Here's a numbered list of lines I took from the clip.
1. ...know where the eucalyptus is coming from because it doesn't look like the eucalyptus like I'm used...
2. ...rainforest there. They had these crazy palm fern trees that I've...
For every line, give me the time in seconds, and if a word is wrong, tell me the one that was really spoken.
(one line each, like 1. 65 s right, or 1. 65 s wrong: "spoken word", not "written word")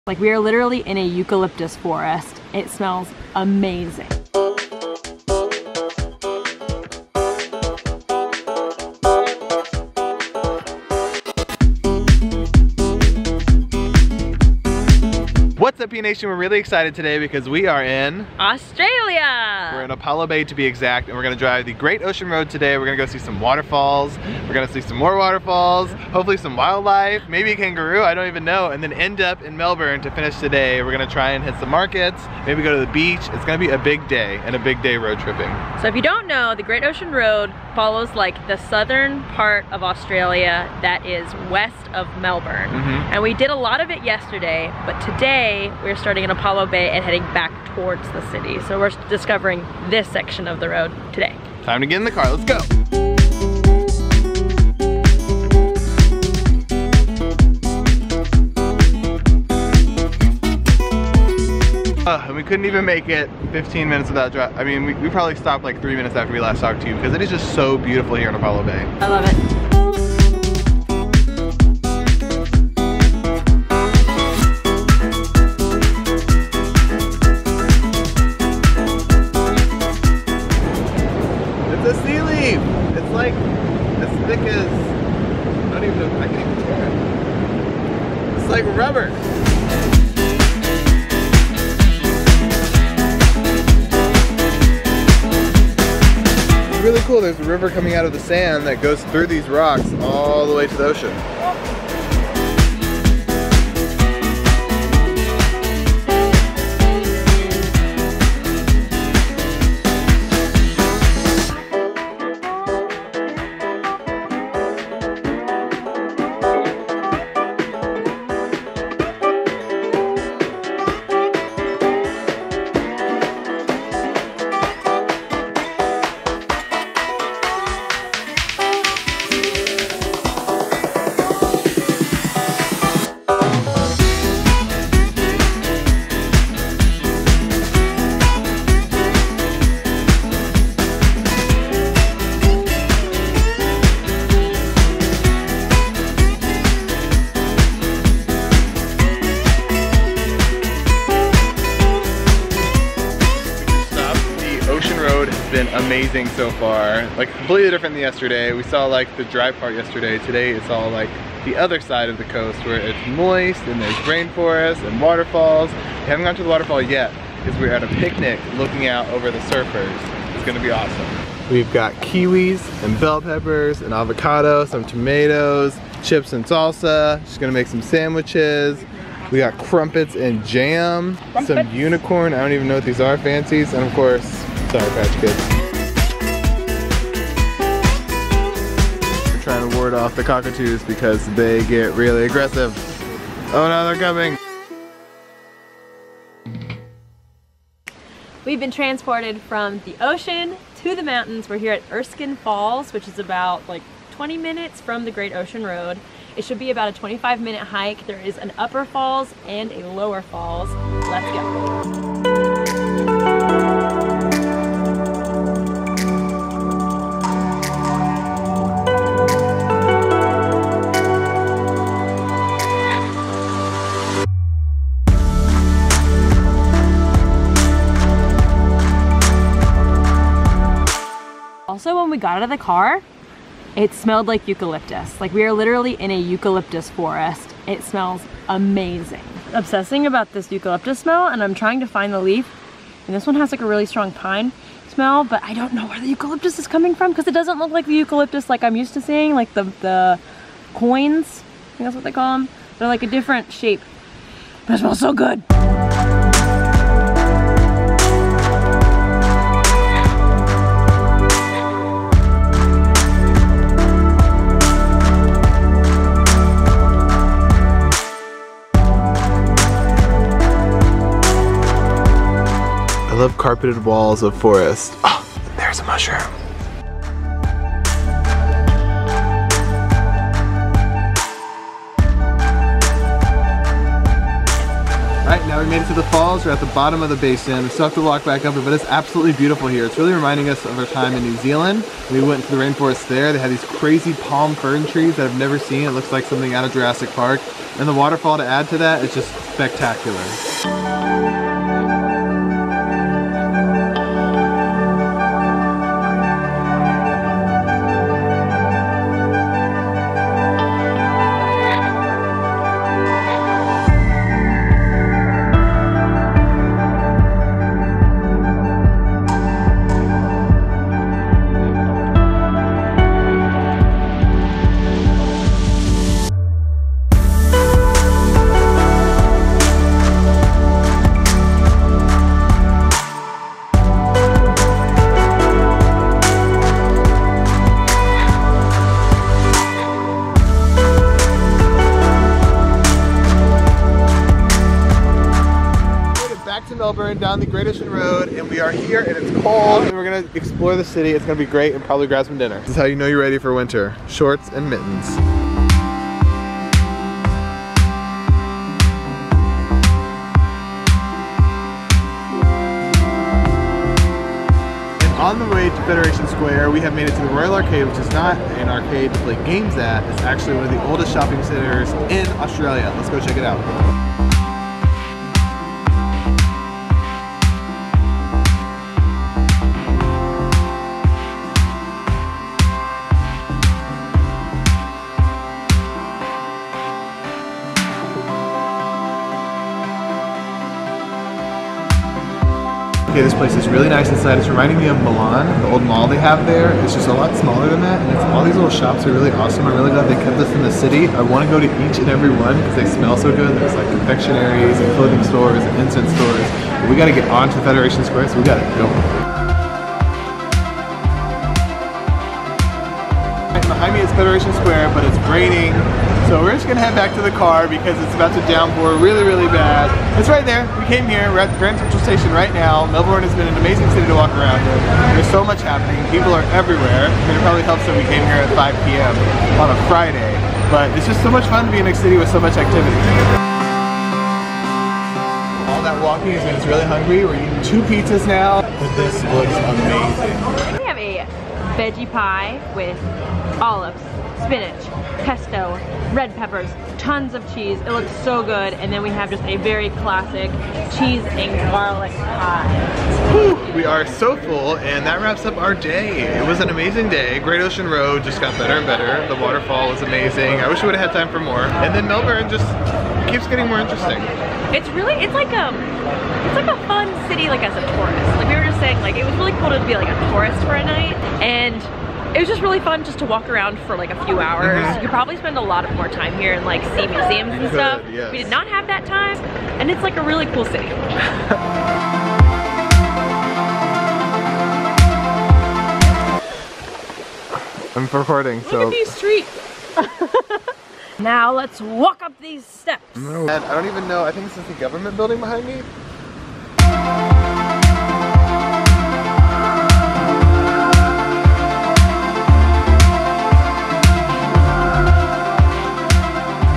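1. 245 s right
2. 292 s right.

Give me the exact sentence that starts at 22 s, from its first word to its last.
We're gonna go see some waterfalls.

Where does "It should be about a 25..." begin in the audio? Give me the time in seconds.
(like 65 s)
206 s.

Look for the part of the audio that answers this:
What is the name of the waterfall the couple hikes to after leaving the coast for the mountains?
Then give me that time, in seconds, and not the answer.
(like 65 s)
201 s.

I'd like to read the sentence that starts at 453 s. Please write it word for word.
Whew, we are so full and that wraps up our day.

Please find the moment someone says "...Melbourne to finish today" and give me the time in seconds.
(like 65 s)
29 s.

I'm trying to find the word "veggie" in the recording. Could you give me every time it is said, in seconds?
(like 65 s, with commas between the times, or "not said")
441 s.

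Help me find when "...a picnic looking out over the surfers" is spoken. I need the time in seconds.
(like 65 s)
167 s.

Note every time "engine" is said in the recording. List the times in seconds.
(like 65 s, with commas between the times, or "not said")
not said.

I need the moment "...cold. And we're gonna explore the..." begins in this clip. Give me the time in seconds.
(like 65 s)
349 s.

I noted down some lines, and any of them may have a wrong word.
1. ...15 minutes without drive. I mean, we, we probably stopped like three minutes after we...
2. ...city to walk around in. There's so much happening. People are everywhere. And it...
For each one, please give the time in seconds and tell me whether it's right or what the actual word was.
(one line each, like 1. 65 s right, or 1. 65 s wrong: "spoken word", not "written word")
1. 63 s right
2. 423 s right.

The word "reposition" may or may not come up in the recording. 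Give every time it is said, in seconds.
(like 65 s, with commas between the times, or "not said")
not said.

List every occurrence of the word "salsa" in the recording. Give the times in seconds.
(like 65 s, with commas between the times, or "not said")
176 s.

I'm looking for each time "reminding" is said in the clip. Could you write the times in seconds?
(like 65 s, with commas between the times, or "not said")
290 s, 394 s.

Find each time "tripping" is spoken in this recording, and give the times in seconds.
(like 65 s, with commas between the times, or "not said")
35 s.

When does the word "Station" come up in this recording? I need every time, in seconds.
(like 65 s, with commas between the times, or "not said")
422 s.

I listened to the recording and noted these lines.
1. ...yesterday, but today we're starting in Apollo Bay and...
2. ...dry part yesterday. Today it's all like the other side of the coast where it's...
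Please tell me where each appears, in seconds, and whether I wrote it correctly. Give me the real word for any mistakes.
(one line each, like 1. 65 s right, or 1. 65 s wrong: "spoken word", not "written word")
1. 44 s right
2. 159 s right.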